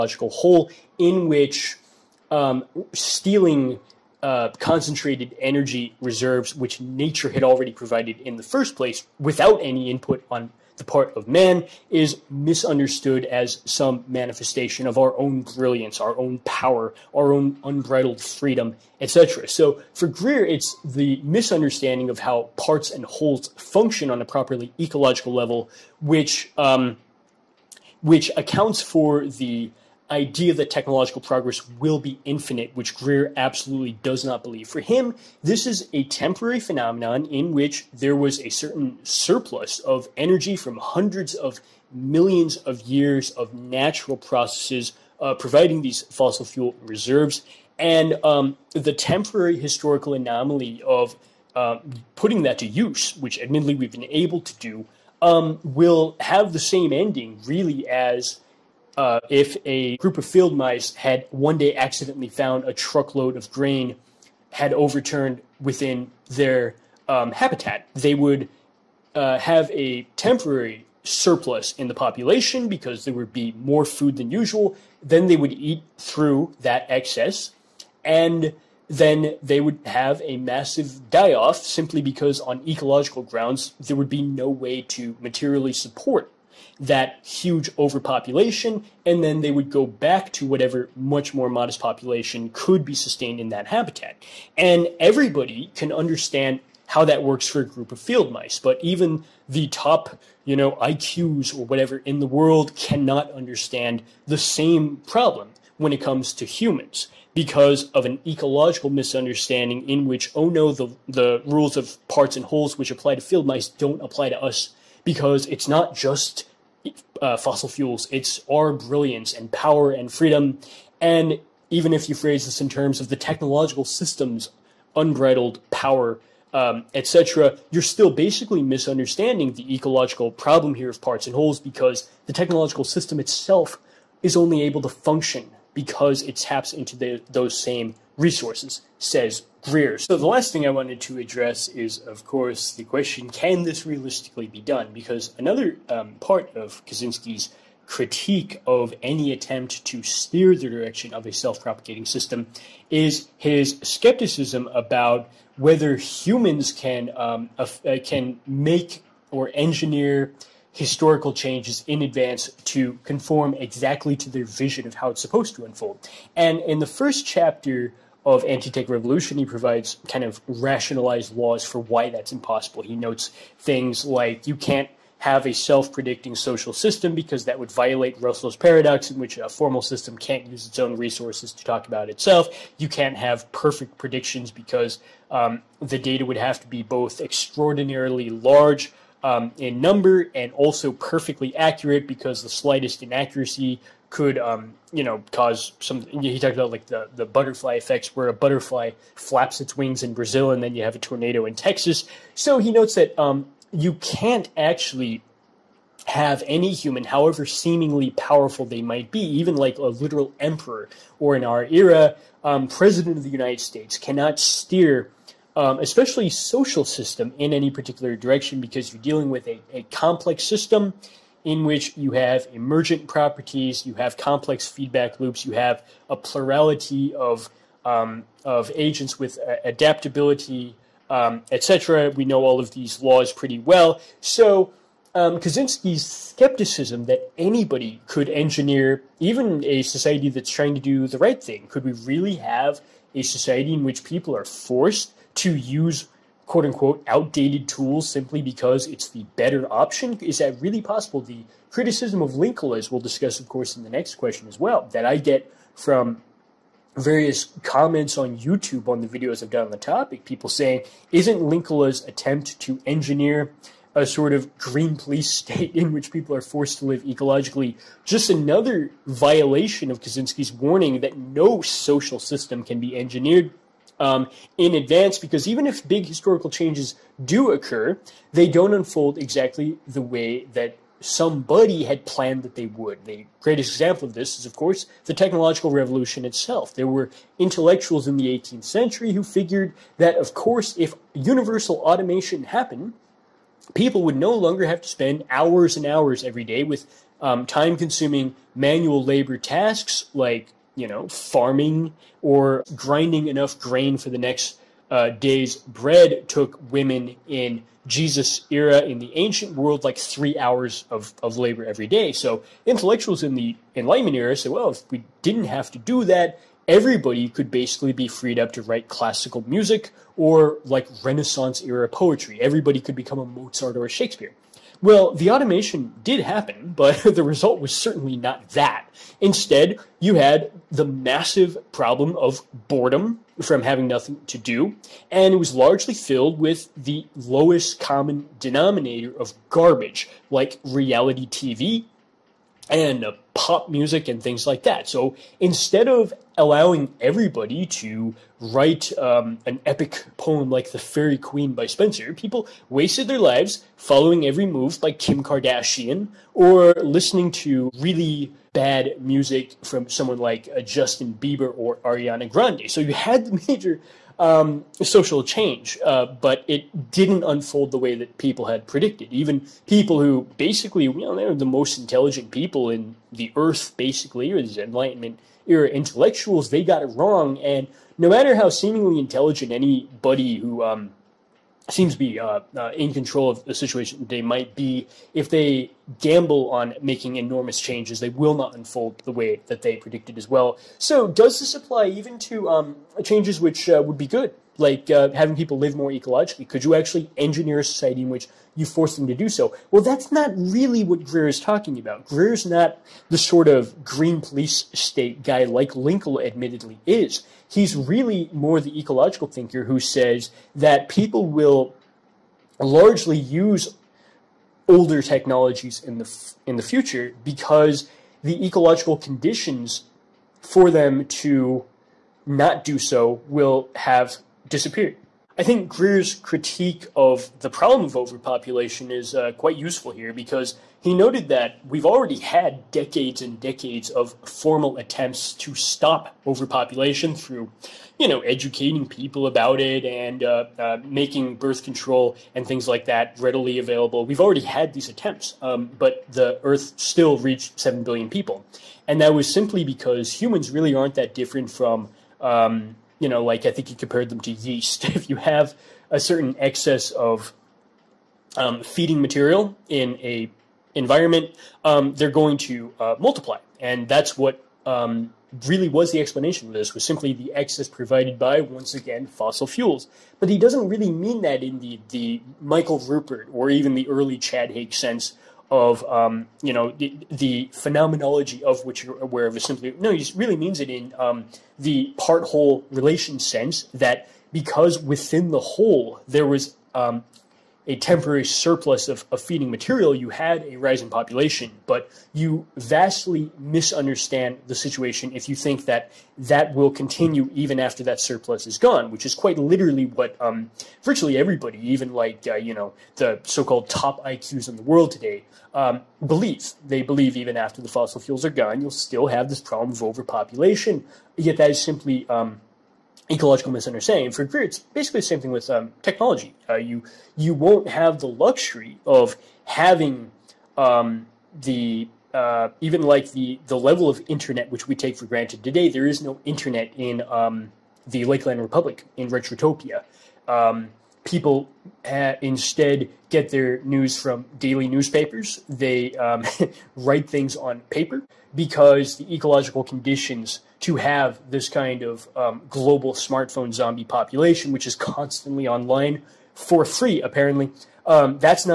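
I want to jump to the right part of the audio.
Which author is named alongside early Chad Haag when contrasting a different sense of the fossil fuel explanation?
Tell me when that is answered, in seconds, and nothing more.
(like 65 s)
472 s.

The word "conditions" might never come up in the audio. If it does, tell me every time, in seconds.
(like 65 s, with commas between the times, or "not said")
418 s, 539 s.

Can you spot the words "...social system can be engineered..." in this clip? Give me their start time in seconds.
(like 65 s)
271 s.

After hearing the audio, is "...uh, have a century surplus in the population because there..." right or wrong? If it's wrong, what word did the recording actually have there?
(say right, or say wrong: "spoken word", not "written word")
wrong: "temporary", not "century".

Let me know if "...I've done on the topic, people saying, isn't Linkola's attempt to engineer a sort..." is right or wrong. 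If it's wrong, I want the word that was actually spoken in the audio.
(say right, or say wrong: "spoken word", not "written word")
right.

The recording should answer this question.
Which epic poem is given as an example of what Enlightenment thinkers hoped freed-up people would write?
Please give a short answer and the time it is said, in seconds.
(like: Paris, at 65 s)
The Faerie Queene, at 350 s.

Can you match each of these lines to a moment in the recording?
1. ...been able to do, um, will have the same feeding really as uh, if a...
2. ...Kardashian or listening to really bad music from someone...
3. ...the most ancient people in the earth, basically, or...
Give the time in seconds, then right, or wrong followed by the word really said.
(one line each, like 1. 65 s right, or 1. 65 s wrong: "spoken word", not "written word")
1. 53 s wrong: "ending", not "feeding"
2. 355 s right
3. 371 s wrong: "intelligent", not "ancient".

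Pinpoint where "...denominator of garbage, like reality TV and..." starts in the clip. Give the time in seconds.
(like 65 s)
338 s.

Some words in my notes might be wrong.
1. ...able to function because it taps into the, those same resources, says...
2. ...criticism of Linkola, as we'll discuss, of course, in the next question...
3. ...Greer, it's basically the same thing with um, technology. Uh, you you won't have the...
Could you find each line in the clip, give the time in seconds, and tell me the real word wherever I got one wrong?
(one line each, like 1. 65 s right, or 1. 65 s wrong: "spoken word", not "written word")
1. 134 s right
2. 251 s right
3. 514 s right.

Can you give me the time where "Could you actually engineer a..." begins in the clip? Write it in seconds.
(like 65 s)
396 s.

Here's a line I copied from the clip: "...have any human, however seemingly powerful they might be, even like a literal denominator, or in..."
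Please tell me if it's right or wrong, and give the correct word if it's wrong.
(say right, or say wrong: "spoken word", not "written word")
wrong: "emperor", not "denominator".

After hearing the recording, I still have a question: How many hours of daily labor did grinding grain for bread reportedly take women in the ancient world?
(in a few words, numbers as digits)
3.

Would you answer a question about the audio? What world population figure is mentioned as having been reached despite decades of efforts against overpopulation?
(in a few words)
7 billion.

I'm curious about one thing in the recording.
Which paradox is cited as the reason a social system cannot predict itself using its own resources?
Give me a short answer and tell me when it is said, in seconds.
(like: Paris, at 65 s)
Russell's paradox, at 178 s.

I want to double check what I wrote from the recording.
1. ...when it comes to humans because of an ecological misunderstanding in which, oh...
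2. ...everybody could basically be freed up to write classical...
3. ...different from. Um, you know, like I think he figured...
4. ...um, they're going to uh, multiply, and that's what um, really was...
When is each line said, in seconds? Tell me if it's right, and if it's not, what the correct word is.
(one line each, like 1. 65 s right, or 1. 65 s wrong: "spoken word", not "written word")
1. 105 s right
2. 316 s right
3. 451 s wrong: "compared", not "figured"
4. 461 s right.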